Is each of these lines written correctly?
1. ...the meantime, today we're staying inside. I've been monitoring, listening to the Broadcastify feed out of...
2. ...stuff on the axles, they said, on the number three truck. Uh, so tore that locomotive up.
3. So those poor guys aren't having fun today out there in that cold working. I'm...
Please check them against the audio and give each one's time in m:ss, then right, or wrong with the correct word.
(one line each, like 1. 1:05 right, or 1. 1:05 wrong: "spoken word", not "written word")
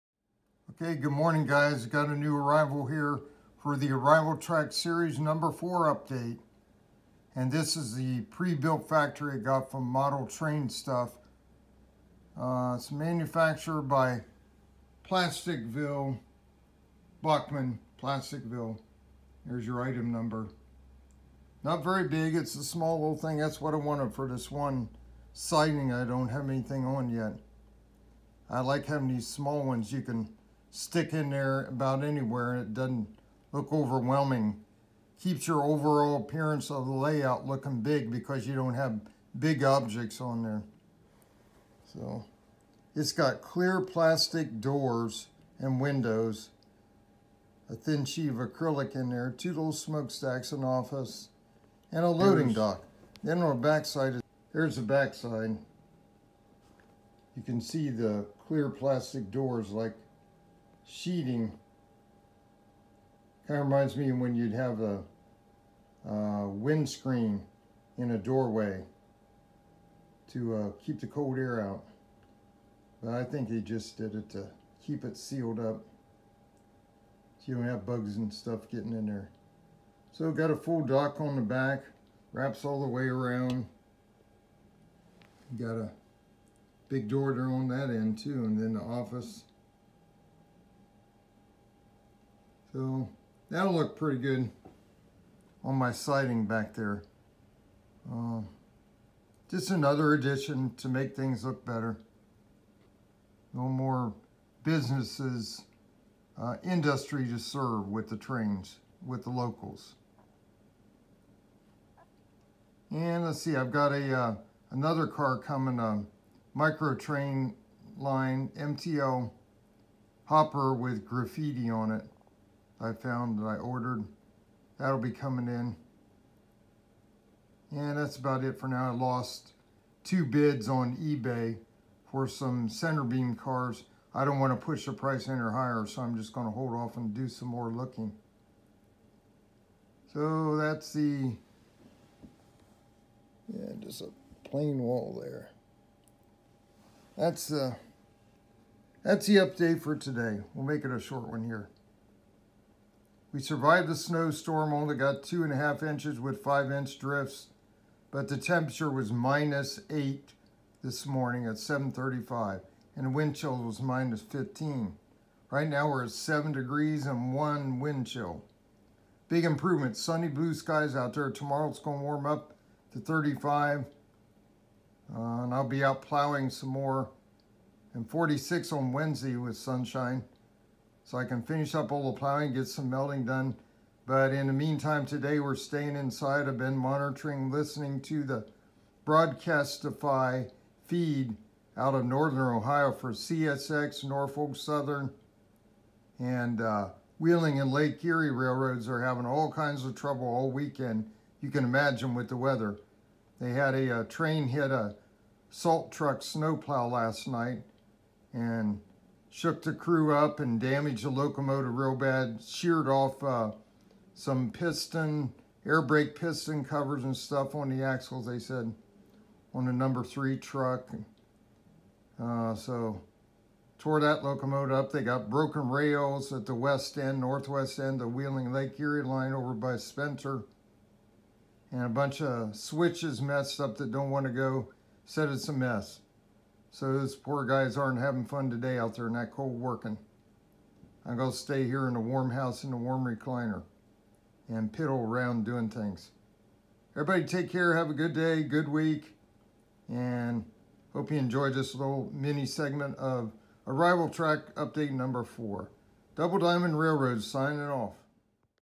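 1. 3:04 right
2. 3:37 right
3. 3:56 right.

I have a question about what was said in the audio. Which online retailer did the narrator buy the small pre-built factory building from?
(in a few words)
Model Train Stuff.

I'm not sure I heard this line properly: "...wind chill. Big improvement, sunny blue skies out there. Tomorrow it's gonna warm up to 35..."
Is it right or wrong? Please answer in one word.
right.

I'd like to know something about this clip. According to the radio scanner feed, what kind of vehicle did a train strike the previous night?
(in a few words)
salt truck snowplow.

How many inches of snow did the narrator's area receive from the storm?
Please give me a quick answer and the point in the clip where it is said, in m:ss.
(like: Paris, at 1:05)
2.5 inches, at 2:35.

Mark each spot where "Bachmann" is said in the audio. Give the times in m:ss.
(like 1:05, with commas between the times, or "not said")
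0:17.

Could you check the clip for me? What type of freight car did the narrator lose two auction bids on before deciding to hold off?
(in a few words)
center beam cars.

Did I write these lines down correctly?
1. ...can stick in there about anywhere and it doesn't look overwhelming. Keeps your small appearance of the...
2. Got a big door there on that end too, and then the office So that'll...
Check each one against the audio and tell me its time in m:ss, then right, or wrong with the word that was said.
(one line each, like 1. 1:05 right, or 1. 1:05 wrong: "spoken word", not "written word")
1. 0:30 wrong: "overall", not "small"
2. 1:25 right.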